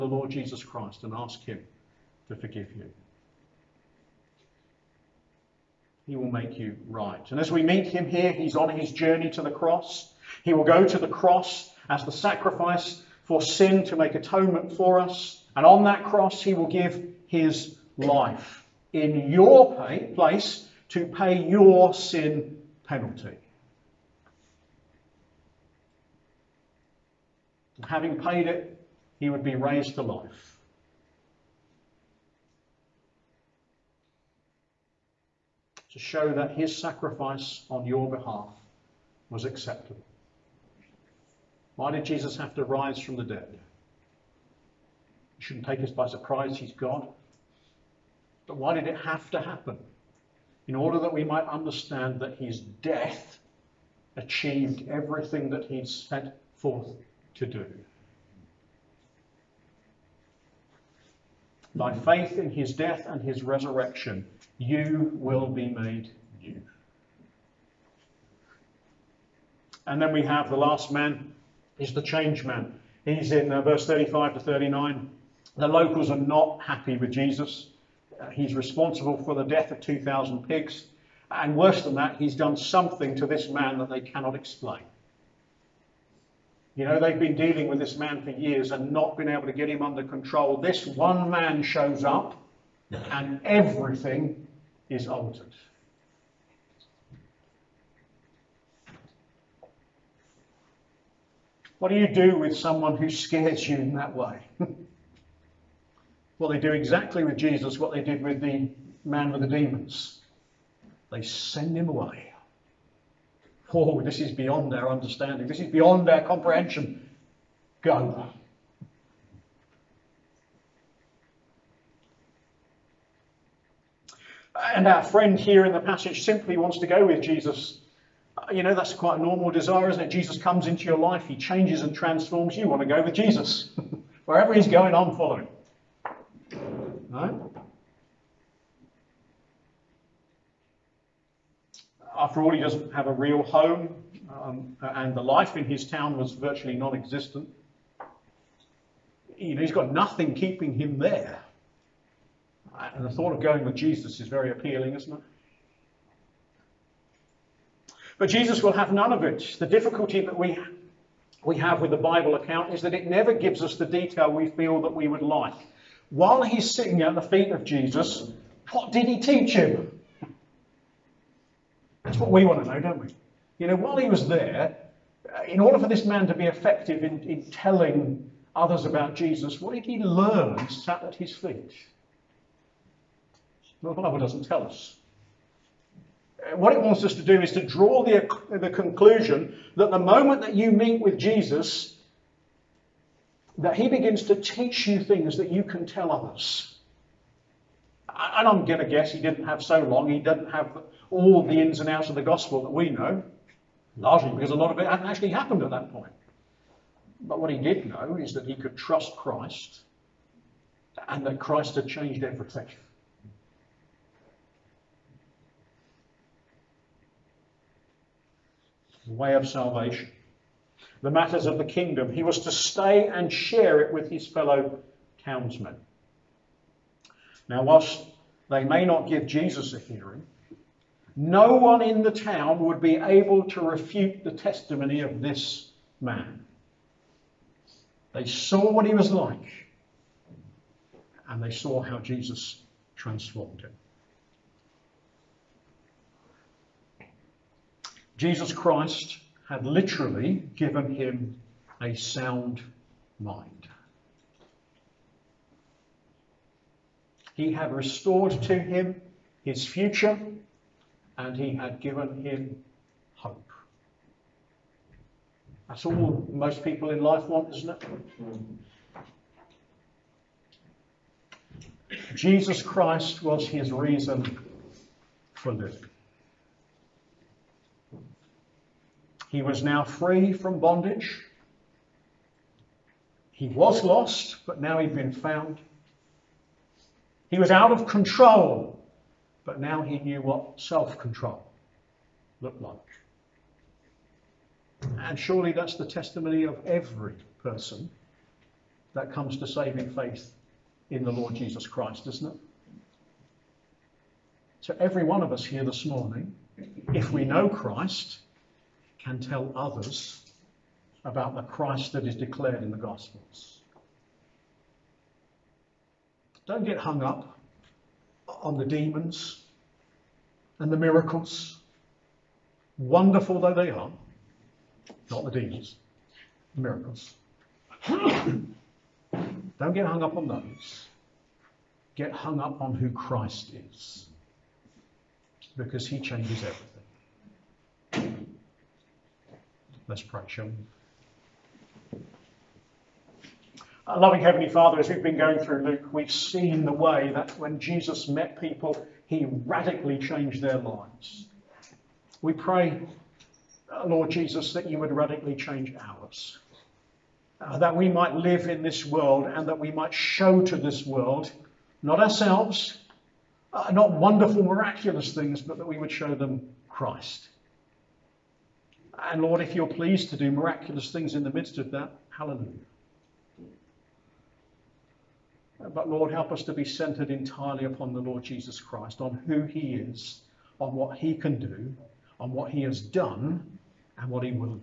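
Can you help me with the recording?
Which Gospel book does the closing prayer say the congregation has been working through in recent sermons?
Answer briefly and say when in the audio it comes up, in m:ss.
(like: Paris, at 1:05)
Luke, at 5:45.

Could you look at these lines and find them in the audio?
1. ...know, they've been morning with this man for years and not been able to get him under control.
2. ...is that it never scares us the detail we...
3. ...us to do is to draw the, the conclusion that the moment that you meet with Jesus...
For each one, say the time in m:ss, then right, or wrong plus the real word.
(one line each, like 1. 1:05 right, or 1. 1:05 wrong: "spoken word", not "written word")
1. 1:26 wrong: "dealing", not "morning"
2. 2:42 wrong: "gives", not "scares"
3. 3:07 right.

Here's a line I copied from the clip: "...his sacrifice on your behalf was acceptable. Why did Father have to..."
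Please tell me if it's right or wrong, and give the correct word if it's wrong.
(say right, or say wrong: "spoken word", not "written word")
wrong: "Jesus", not "Father".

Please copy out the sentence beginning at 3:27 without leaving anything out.
But what he did know is that he could trust Christ and that Christ had changed everything.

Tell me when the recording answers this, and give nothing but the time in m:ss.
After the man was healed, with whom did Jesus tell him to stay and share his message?
3:44.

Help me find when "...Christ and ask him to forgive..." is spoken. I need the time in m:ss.
0:00.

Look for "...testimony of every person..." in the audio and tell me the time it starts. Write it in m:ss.
4:55.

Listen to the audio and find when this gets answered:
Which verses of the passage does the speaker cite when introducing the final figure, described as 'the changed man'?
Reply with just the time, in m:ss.
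1:13.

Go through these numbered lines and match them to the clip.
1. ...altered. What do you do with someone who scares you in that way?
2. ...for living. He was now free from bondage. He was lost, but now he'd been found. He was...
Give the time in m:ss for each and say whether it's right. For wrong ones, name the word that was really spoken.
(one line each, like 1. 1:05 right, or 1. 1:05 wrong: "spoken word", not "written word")
1. 1:35 right
2. 4:35 right.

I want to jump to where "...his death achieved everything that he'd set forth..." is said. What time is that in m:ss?
0:52.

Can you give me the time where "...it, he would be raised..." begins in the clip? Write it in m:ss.
0:28.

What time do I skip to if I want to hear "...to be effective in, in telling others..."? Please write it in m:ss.
2:56.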